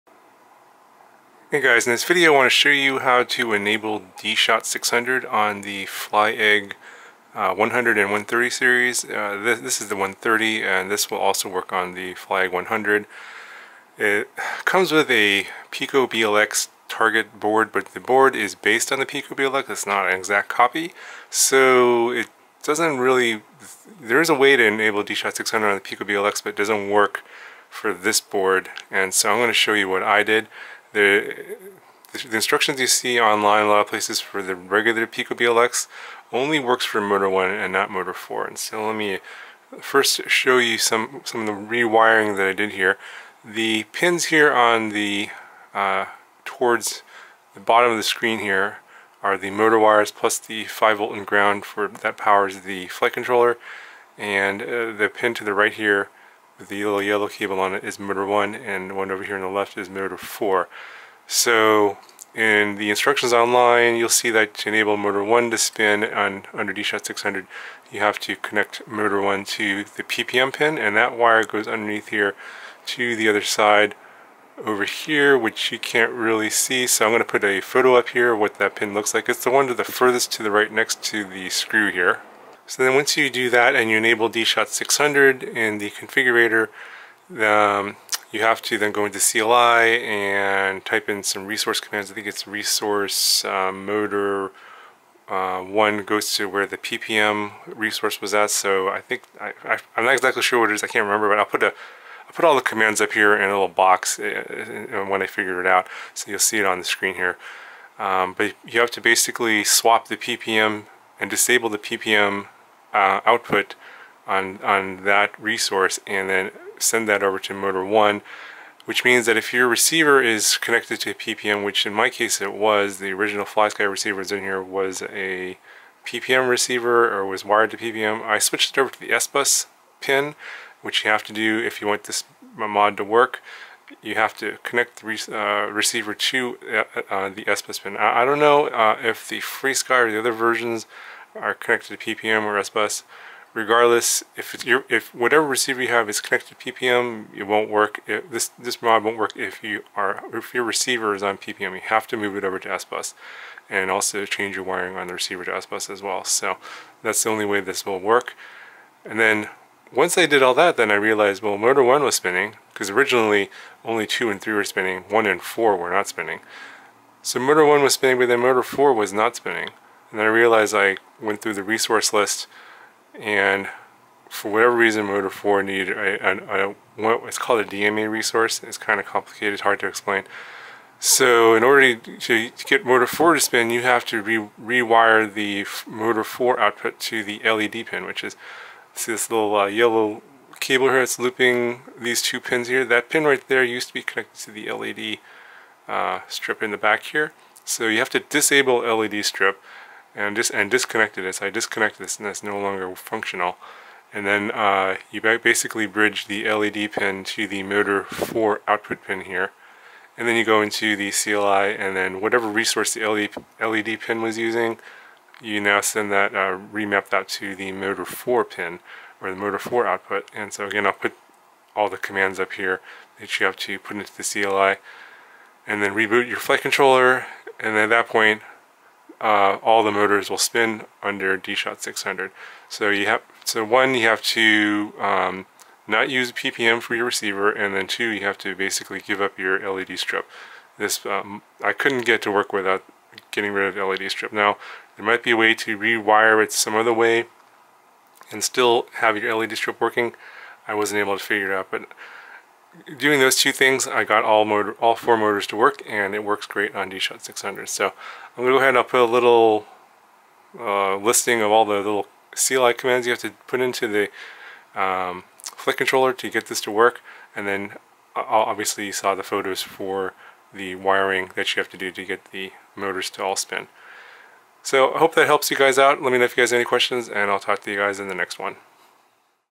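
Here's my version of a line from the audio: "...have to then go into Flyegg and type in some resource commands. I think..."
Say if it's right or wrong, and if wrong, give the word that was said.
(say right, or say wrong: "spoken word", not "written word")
wrong: "CLI", not "Flyegg".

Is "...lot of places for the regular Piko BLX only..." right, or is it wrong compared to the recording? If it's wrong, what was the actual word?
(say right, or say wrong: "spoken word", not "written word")
right.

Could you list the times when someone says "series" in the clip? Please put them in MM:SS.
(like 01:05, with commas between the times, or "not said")
00:08.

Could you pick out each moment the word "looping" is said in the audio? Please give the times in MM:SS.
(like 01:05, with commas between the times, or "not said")
03:11.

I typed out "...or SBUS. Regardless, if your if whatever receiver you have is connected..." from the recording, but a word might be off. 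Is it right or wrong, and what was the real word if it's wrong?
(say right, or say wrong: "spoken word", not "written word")
right.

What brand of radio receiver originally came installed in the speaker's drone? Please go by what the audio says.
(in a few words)
FlySky.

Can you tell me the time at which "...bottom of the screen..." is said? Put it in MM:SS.
00:47.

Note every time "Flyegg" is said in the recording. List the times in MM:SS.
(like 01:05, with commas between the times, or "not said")
00:05, 00:12.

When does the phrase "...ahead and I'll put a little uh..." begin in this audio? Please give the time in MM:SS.
04:18.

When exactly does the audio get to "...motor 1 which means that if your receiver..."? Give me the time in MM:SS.
01:57.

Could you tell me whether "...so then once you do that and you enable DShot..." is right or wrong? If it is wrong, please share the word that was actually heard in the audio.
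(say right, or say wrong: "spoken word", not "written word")
right.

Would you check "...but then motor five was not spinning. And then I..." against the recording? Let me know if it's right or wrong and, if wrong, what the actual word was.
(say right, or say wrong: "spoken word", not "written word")
wrong: "four", not "five".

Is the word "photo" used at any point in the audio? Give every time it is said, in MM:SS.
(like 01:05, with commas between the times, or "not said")
01:17, 04:29.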